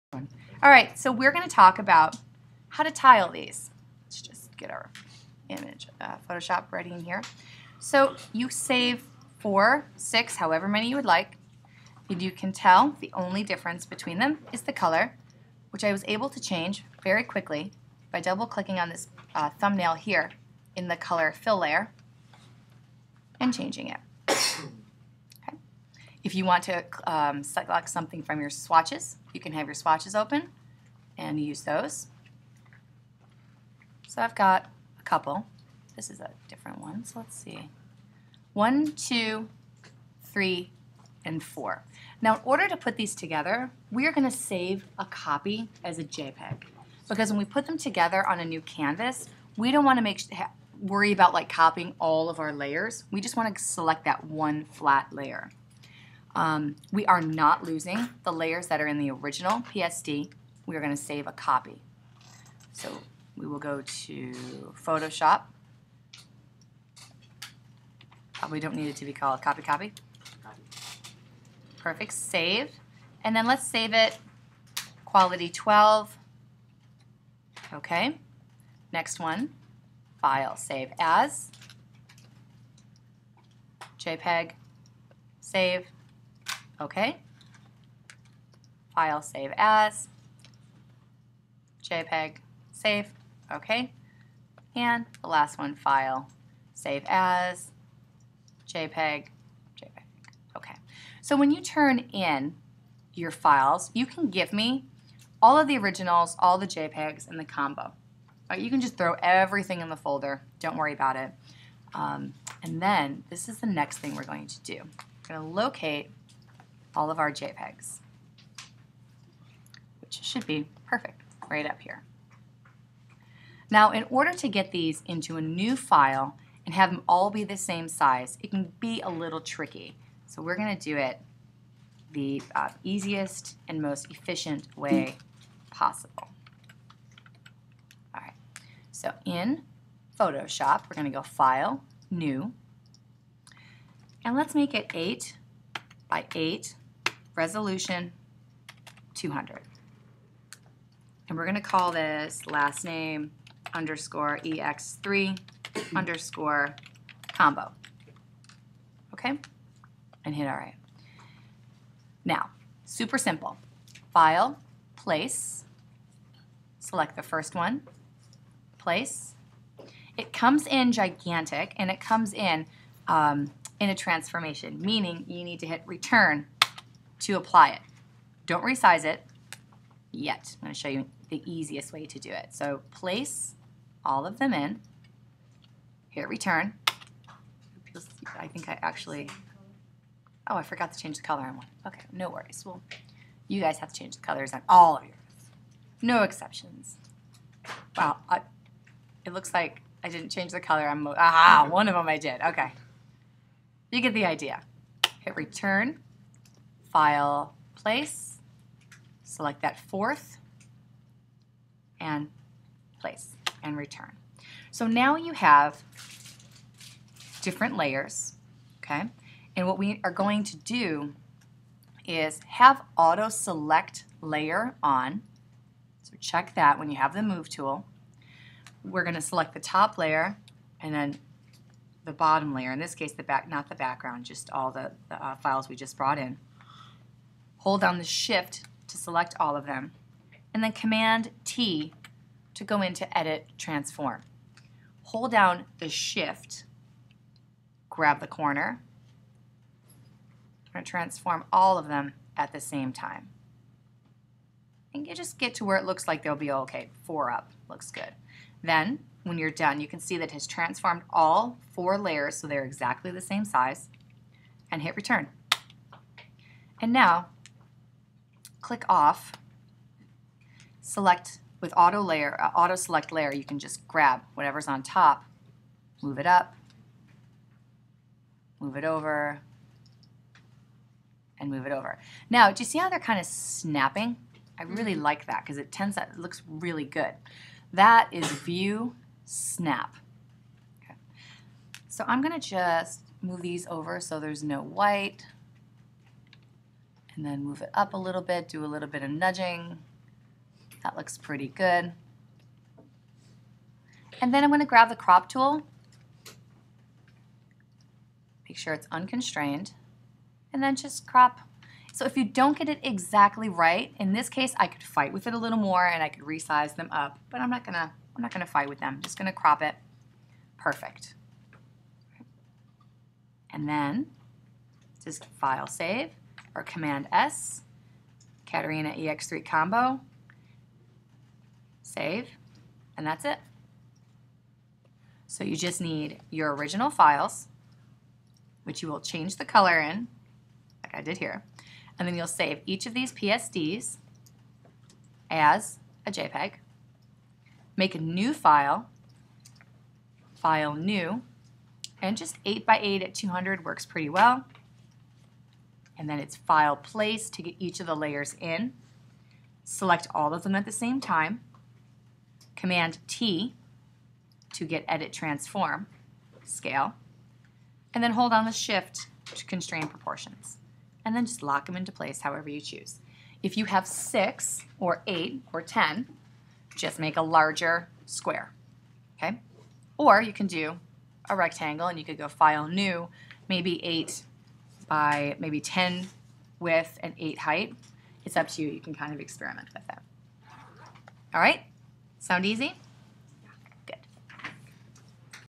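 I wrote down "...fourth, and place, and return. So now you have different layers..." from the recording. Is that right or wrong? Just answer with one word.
right.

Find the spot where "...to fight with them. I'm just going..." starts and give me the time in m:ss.
5:18.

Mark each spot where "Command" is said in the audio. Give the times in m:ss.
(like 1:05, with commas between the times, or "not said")
4:00, 5:26, 6:02.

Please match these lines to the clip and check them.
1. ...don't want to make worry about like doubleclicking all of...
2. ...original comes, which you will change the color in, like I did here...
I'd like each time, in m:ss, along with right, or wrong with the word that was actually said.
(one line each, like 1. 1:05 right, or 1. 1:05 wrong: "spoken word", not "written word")
1. 0:49 wrong: "copying", not "doubleclicking"
2. 5:36 wrong: "files", not "comes".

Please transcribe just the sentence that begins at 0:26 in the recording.
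If you want to um, select something from your swatches, you can have your swatches open and use those.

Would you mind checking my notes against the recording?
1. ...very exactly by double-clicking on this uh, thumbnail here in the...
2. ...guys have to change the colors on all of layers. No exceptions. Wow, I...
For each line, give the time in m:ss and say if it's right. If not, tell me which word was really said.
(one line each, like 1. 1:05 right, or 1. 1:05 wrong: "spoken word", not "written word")
1. 0:17 wrong: "quickly", not "exactly"
2. 3:13 wrong: "yours", not "layers".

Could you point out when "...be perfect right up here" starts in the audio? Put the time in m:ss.
2:00.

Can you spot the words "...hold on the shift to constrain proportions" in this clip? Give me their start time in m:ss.
6:08.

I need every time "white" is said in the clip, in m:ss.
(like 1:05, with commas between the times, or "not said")
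4:54.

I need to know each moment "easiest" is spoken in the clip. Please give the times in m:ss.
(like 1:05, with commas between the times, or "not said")
2:12, 3:01.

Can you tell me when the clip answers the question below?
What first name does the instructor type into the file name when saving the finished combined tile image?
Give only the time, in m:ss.
5:28.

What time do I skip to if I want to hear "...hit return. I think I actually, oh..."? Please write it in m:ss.
3:06.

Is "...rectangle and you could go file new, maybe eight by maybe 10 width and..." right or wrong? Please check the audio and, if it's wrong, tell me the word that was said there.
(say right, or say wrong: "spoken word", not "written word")
right.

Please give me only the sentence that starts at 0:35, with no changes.
This is a different one, so let's see.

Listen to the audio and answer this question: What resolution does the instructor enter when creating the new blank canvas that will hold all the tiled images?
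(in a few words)
200.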